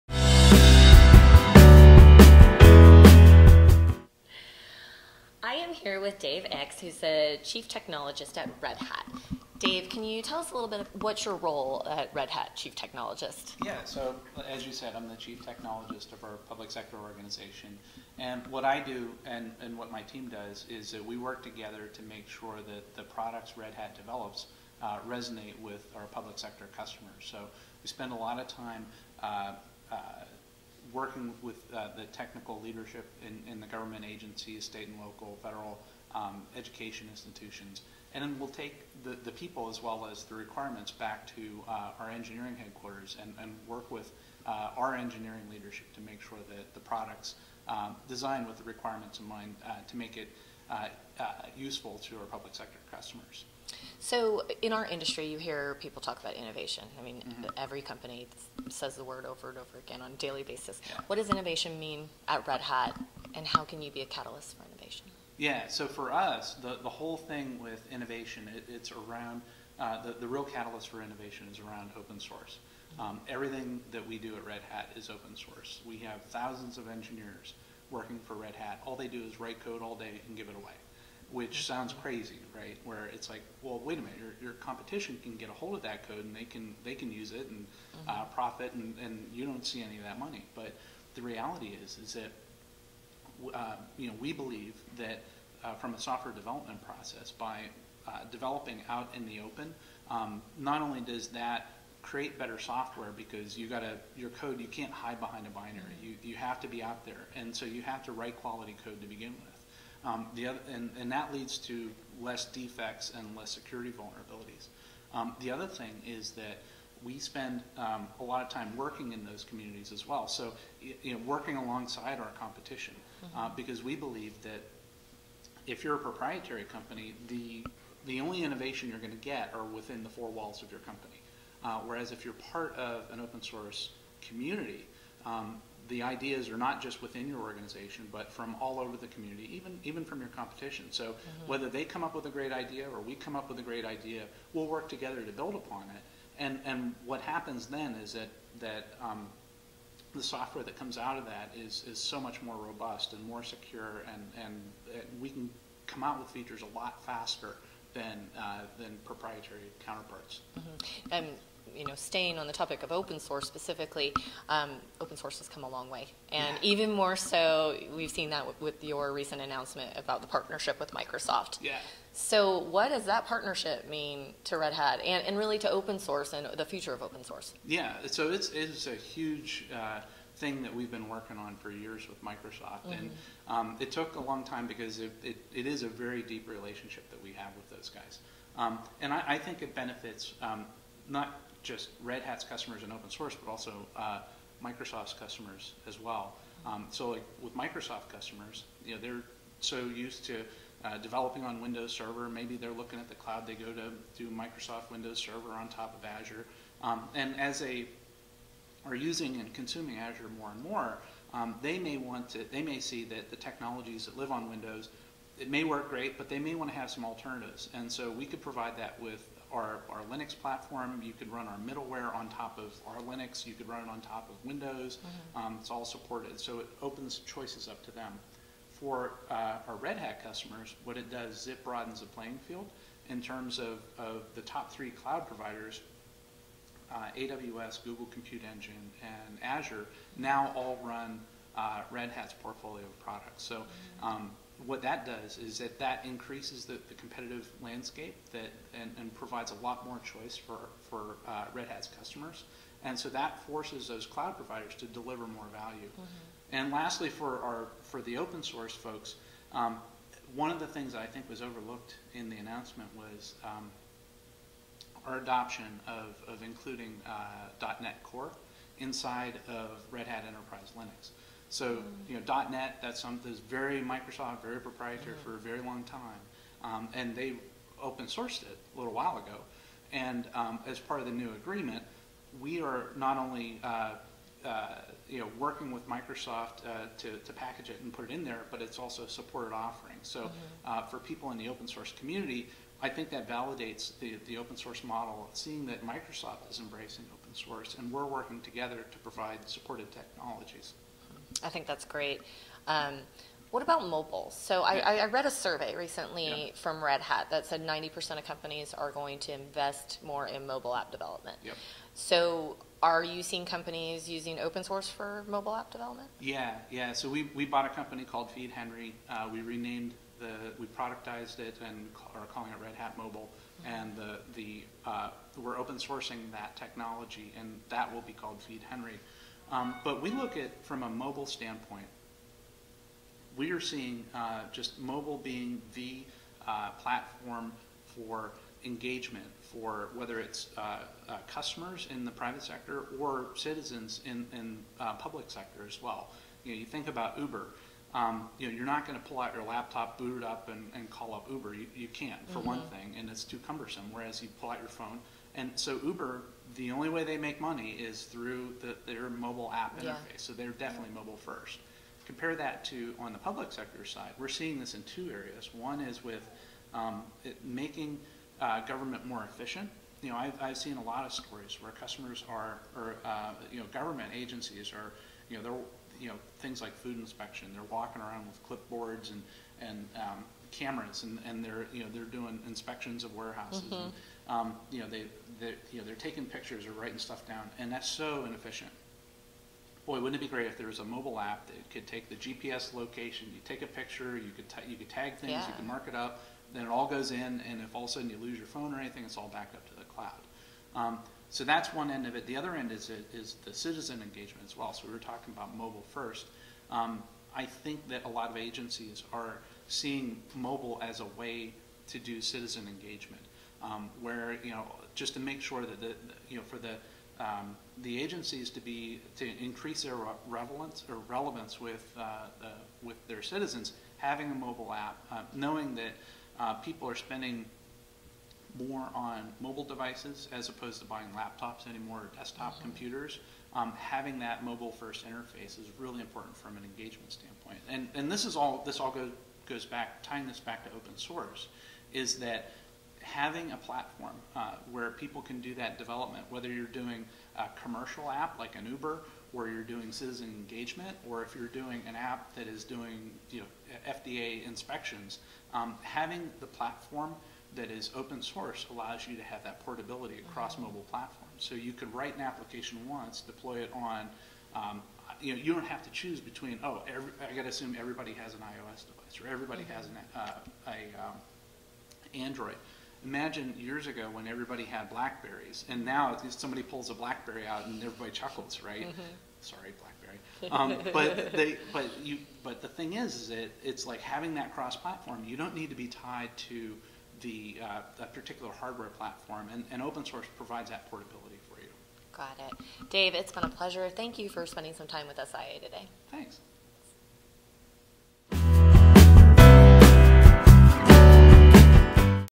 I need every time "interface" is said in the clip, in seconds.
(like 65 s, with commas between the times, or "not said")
359 s, 435 s.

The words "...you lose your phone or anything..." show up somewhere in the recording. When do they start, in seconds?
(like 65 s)
398 s.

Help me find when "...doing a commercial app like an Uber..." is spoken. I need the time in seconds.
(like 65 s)
446 s.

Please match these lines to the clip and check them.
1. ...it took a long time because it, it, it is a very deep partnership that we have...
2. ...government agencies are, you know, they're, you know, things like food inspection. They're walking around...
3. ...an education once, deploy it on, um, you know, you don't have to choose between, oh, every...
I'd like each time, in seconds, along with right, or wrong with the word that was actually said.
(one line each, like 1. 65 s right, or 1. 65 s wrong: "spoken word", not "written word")
1. 183 s wrong: "relationship", not "partnership"
2. 373 s right
3. 462 s wrong: "application", not "education".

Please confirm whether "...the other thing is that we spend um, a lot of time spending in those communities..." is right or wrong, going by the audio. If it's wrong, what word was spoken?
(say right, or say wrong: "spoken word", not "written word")
wrong: "working", not "spending".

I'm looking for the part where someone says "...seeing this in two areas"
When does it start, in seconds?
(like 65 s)
364 s.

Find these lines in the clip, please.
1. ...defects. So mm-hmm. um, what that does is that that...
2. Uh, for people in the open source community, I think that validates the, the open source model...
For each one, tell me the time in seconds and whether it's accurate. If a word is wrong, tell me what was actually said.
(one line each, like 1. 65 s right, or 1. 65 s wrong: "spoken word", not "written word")
1. 242 s wrong: "products", not "defects"
2. 290 s right.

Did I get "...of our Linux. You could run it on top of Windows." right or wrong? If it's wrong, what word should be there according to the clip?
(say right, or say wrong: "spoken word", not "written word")
right.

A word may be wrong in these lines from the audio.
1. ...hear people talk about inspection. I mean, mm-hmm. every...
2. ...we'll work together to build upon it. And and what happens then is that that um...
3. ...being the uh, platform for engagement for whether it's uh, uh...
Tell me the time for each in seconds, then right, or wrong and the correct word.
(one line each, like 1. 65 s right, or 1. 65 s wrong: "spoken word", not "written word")
1. 55 s wrong: "innovation", not "inspection"
2. 144 s right
3. 335 s right.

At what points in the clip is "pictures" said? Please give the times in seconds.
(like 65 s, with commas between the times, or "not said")
386 s, 393 s.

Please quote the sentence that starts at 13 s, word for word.
Yeah, so as you said, I'm the chief technologist of our public sector organization.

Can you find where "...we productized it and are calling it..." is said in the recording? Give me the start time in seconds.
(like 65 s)
320 s.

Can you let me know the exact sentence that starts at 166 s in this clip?
even more so, we've seen that with your recent announcement about the partnership with Microsoft.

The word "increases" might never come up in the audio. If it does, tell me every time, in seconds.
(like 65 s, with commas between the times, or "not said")
246 s, 419 s.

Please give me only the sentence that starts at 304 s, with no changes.
So I, I read a survey recently yeah.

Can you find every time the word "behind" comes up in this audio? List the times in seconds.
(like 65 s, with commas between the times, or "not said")
105 s.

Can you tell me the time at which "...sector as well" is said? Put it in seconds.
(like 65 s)
345 s.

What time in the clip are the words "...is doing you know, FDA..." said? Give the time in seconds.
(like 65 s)
452 s.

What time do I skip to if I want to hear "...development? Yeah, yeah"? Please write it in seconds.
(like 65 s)
315 s.